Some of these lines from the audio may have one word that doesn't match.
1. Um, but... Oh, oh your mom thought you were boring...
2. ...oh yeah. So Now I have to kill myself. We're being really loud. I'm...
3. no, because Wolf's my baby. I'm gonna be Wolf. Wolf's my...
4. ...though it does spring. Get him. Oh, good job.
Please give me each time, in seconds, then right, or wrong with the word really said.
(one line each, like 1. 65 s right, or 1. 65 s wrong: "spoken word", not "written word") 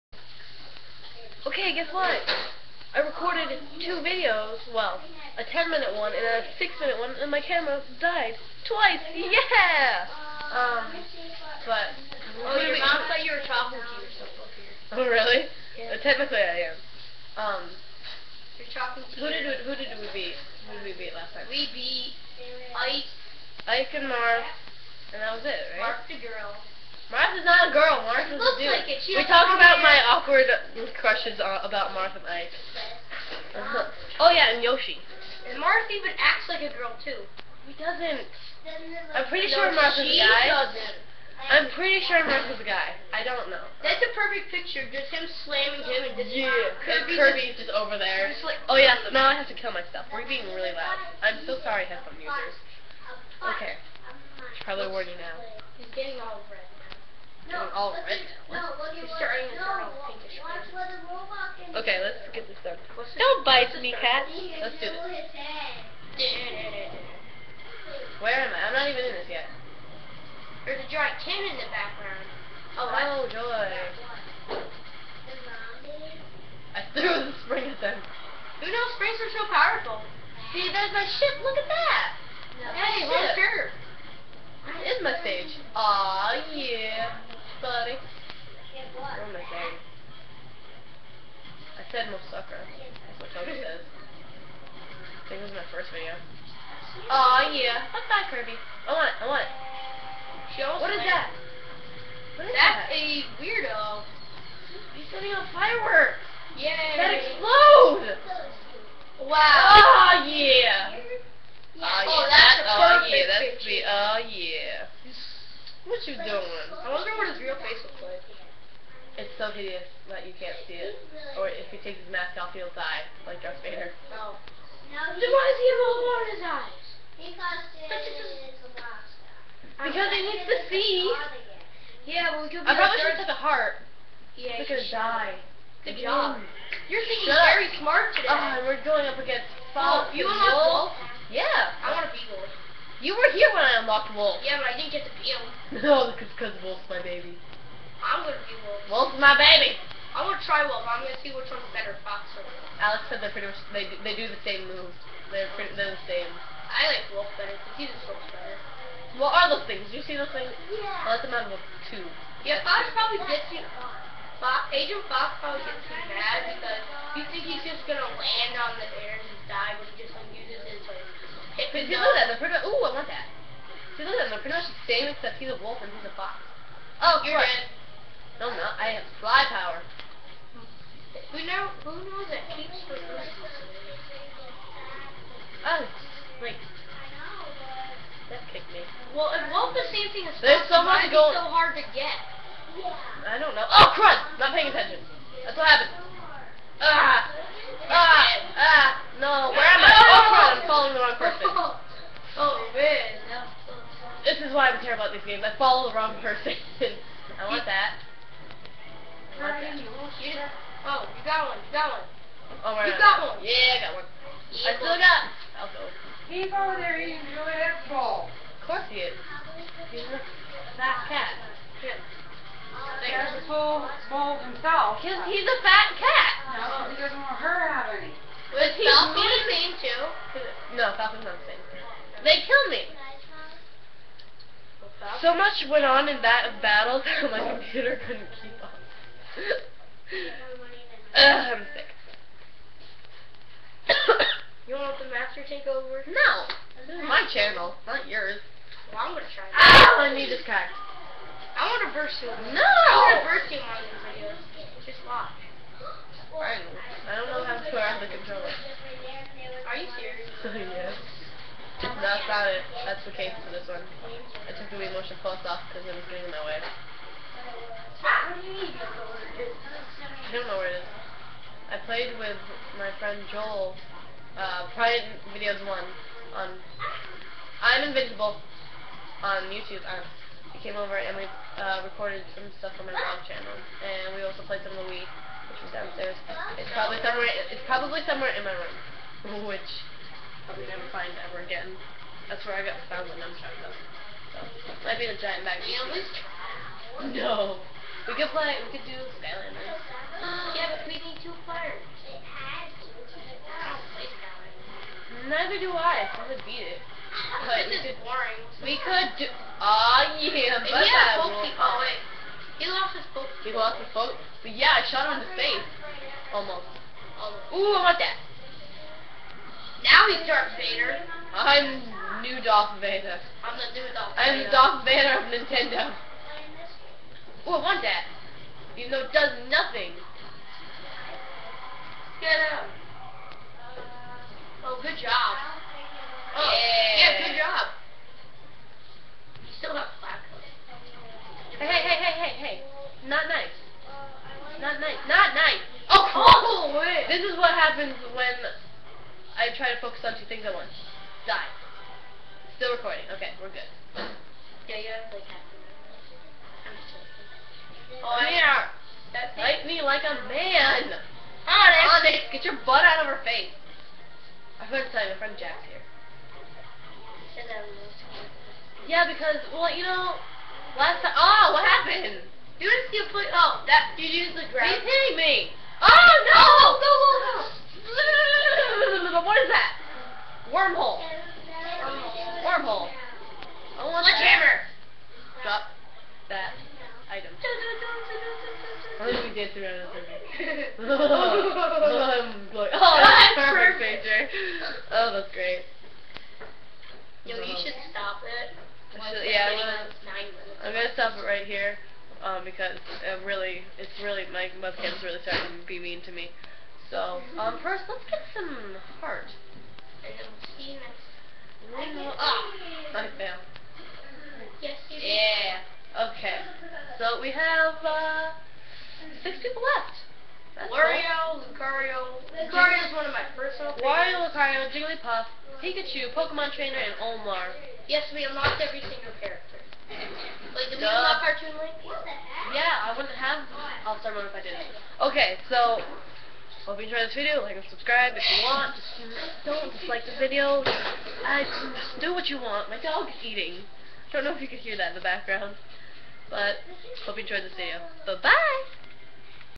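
1. 10 s wrong: "talking", not "boring"
2. 48 s right
3. 145 s right
4. 328 s wrong: "nothing", not "spring".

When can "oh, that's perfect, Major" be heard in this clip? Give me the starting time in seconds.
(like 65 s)
392 s.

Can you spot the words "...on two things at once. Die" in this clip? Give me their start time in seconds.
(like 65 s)
350 s.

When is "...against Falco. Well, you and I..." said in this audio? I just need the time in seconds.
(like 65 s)
139 s.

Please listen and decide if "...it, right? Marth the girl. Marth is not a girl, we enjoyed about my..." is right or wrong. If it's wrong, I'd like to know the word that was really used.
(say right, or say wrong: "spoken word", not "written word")
wrong: "talked", not "enjoyed".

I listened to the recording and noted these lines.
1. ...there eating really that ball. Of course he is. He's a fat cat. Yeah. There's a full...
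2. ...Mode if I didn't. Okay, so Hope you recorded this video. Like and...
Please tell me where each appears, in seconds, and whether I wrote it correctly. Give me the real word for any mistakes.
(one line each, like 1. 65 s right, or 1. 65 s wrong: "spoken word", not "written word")
1. 216 s right
2. 434 s wrong: "enjoyed", not "recorded".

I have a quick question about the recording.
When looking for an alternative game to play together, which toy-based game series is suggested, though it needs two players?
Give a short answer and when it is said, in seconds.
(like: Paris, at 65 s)
Skylanders, at 299 s.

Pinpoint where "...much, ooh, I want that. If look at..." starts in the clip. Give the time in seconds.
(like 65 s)
172 s.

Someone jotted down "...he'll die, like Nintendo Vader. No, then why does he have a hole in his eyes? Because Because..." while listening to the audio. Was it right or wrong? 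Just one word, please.
wrong.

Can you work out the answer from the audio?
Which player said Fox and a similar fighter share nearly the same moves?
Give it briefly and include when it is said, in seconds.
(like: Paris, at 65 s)
Alex, at 152 s.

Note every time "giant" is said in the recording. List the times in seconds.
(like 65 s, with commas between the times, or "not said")
70 s, 295 s.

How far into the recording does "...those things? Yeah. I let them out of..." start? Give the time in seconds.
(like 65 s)
160 s.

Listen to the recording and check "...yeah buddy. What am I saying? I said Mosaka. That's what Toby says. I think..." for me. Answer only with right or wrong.
right.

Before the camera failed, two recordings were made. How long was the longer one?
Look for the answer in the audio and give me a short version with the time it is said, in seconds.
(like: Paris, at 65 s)
10 minutes, at 5 s.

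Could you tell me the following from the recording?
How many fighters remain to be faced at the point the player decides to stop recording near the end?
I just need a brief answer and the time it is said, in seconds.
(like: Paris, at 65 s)
6, at 419 s.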